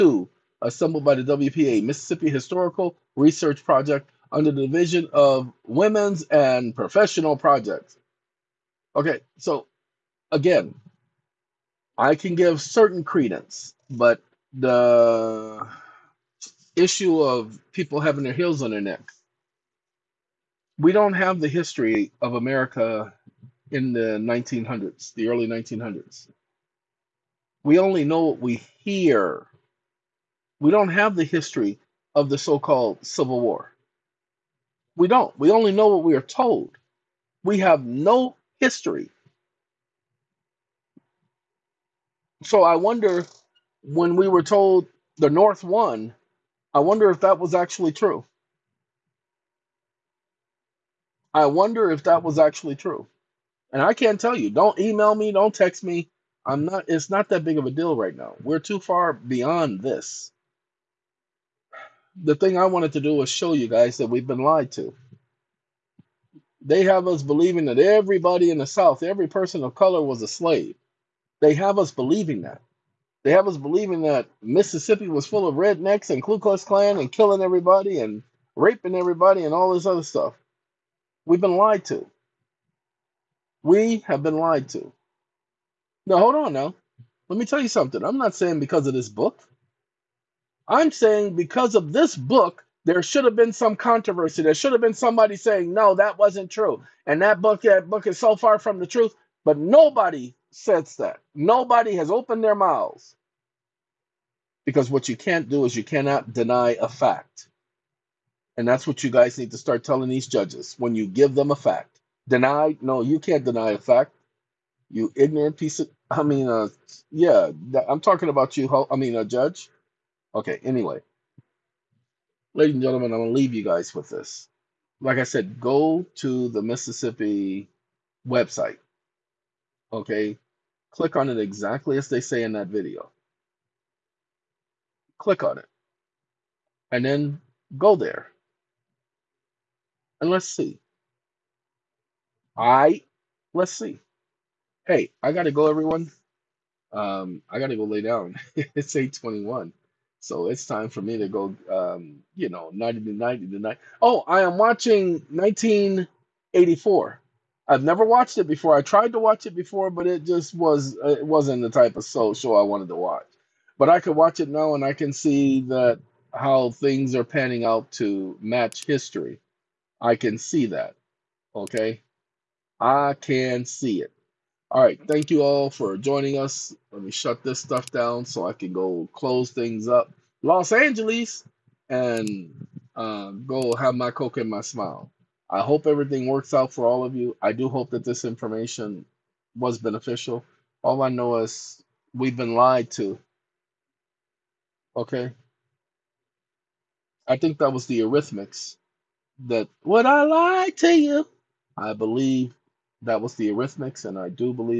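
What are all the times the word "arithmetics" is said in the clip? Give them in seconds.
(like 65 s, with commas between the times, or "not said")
198 s, 203 s.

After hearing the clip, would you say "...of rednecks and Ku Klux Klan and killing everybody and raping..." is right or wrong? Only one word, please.
right.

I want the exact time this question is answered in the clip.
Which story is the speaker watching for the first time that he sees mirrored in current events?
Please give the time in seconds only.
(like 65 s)
155 s.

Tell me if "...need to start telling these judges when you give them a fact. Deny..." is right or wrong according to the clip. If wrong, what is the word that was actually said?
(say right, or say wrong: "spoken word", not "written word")
right.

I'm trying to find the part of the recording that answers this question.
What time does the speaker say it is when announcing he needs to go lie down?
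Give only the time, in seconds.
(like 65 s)
148 s.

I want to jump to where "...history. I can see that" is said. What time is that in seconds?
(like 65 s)
168 s.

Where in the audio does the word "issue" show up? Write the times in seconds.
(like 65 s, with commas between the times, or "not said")
16 s.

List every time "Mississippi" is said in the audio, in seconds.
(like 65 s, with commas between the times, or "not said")
1 s, 74 s, 126 s.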